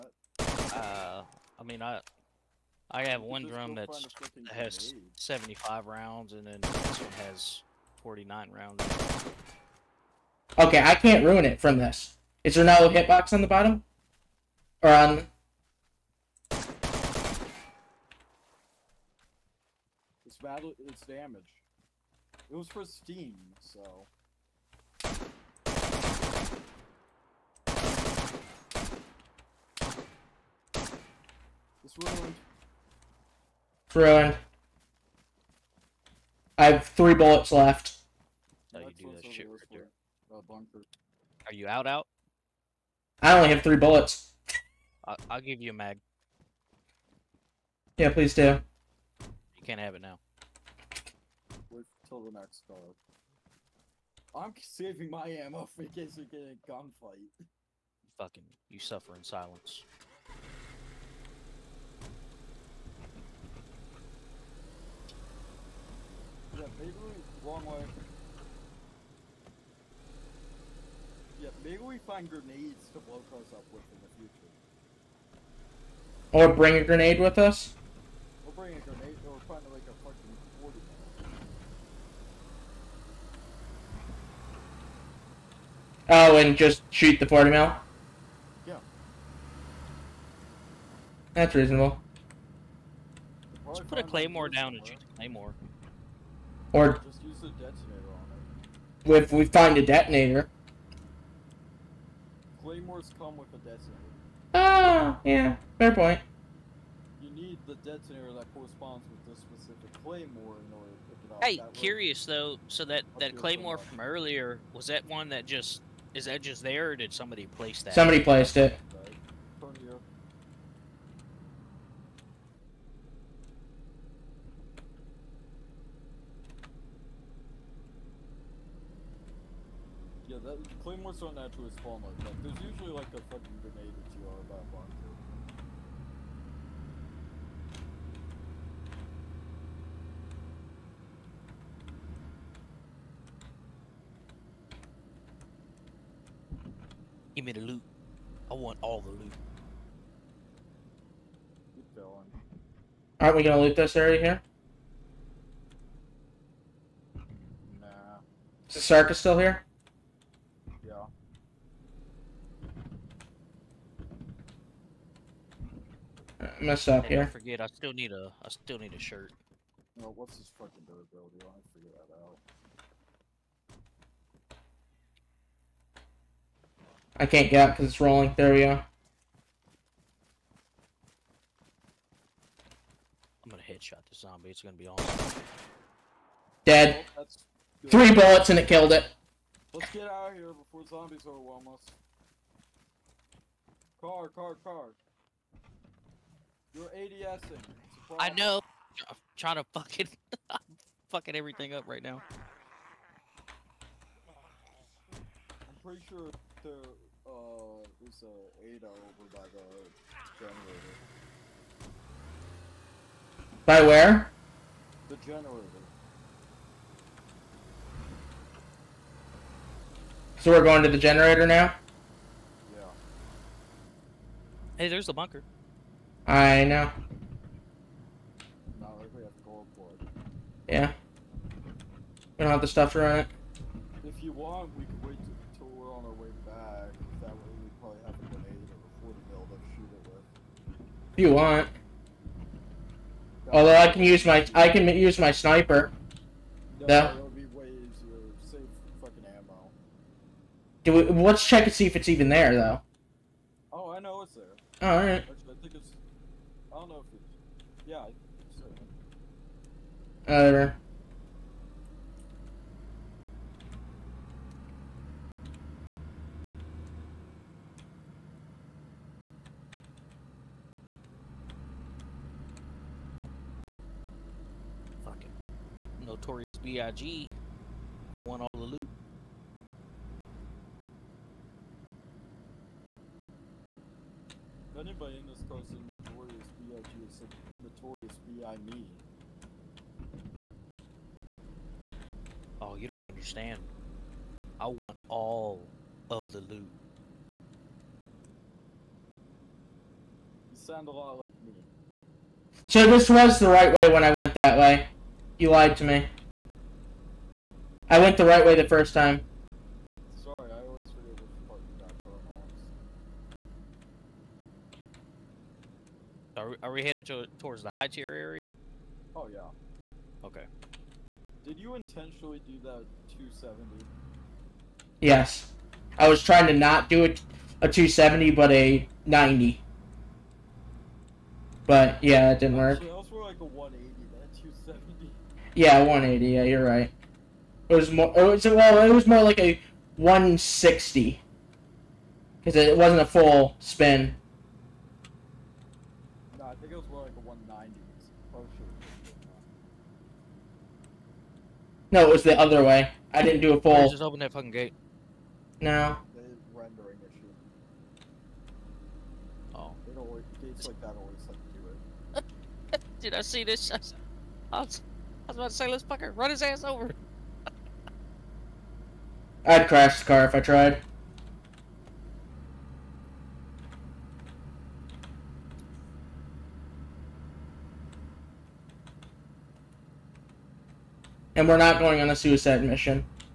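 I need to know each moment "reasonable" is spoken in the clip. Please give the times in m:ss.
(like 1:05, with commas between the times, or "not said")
1:31.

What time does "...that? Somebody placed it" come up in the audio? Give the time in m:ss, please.
1:57.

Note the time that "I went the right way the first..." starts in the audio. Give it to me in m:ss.
5:07.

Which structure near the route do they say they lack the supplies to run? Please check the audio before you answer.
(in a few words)
The bunker.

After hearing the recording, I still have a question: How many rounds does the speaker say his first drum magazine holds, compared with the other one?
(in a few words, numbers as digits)
75.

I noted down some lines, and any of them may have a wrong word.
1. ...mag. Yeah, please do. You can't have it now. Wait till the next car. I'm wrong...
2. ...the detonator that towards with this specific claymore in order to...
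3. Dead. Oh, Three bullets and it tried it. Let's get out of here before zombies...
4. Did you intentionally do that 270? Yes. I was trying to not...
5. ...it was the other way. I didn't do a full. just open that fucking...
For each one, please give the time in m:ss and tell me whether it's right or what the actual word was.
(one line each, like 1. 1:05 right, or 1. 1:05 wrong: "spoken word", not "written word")
1. 0:45 wrong: "saving", not "wrong"
2. 1:47 wrong: "corresponds", not "towards"
3. 3:06 wrong: "killed", not "tried"
4. 5:21 right
5. 5:52 right.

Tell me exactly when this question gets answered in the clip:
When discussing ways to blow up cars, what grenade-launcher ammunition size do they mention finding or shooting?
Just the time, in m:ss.
1:27.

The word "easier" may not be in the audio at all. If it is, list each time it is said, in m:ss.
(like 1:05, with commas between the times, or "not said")
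4:07.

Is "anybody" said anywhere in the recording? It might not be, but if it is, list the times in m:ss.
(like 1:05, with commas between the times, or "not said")
4:44.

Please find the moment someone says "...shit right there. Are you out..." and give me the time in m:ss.
0:39.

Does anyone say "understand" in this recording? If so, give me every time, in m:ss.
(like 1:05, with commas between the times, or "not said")
4:53.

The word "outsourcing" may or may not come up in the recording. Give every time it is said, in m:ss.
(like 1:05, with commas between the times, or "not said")
not said.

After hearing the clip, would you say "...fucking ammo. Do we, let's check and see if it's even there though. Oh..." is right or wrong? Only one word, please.
right.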